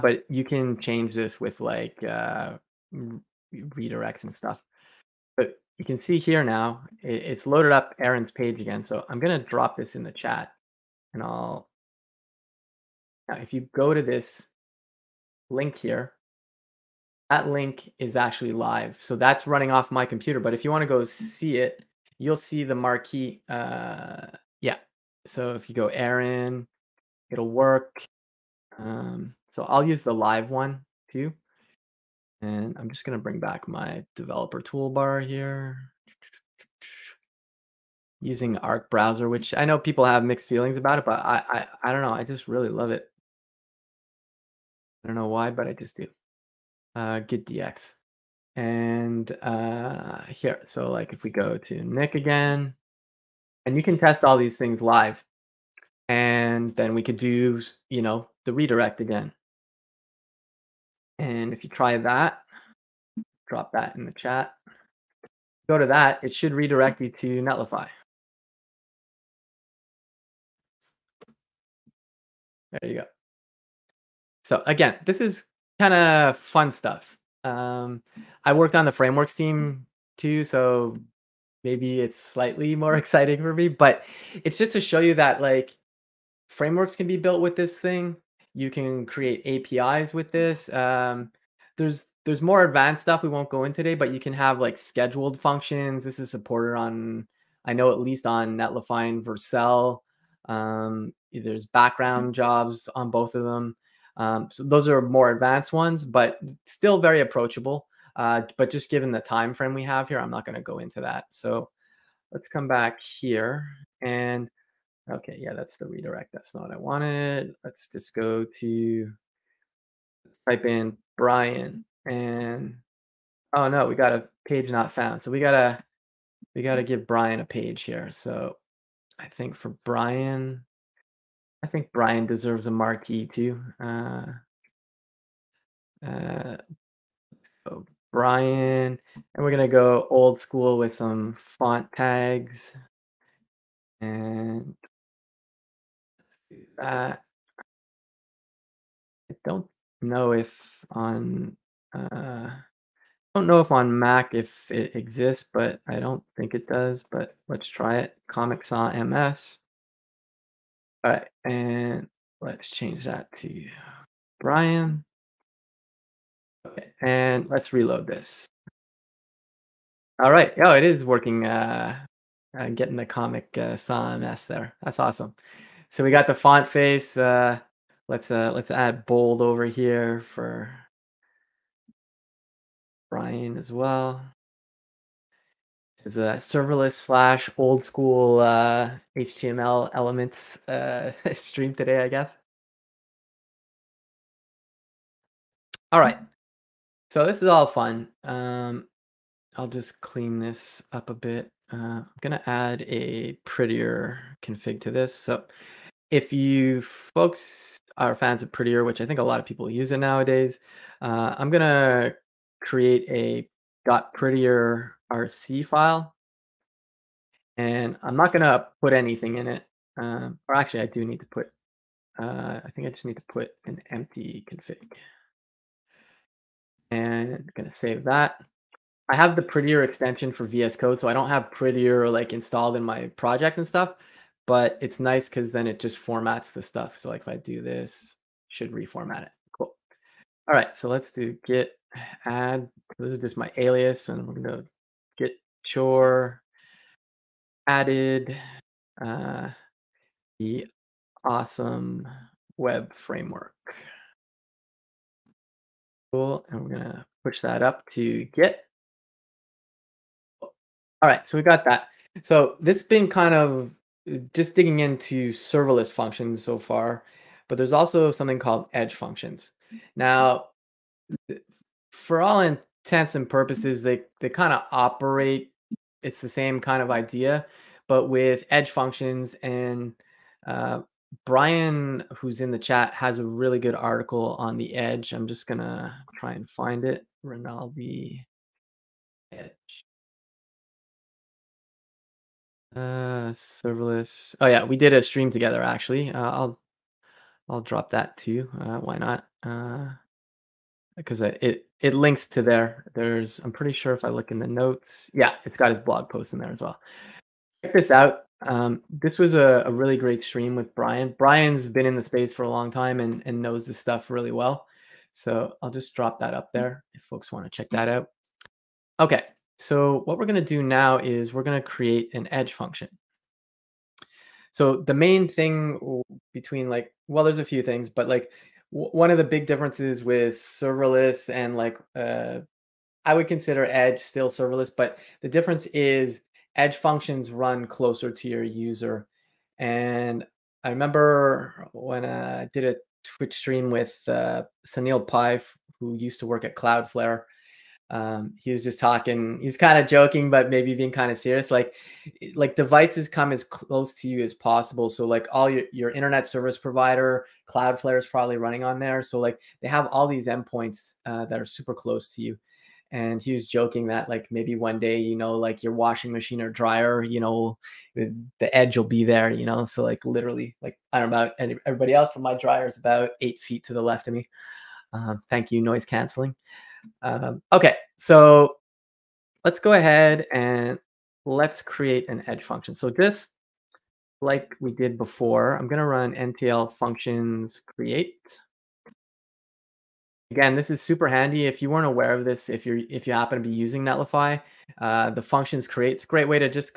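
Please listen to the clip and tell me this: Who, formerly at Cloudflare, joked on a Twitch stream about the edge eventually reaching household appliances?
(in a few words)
Sunil Pai.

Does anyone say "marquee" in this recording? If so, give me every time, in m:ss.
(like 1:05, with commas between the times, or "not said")
0:22, 2:12.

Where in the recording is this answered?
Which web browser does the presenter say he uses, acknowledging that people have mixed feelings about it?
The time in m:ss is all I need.
0:38.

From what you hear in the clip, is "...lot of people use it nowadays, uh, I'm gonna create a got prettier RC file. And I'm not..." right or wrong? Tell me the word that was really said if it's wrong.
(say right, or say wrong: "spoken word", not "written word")
right.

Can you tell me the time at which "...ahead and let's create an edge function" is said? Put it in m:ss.
6:19.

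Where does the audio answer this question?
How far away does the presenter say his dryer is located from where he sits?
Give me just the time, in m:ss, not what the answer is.
6:13.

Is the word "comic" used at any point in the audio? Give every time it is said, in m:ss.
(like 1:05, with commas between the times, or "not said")
2:38, 2:53.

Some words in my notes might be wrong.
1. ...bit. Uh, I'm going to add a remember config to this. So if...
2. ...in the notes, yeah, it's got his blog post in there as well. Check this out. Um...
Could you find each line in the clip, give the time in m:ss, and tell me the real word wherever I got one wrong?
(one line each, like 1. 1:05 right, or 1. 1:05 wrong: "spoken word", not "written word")
1. 3:21 wrong: "prettier", not "remember"
2. 5:04 right.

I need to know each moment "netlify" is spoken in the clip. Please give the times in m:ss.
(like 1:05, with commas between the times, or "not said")
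1:07, 1:38, 6:33.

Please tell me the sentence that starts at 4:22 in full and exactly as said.
So this has been kind of just digging into serverless functions so far, but there's also something called edge functions.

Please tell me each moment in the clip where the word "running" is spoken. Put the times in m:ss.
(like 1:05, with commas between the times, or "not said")
0:19, 5:58.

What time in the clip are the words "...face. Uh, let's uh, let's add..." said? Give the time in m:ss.
2:56.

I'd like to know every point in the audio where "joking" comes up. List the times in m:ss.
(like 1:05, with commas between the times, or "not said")
5:49, 6:03.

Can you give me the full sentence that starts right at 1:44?
Um, so those are more advanced ones, but still very approachable.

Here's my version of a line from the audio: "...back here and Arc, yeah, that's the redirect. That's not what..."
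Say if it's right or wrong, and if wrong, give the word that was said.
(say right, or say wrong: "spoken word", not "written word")
wrong: "Okay", not "Arc".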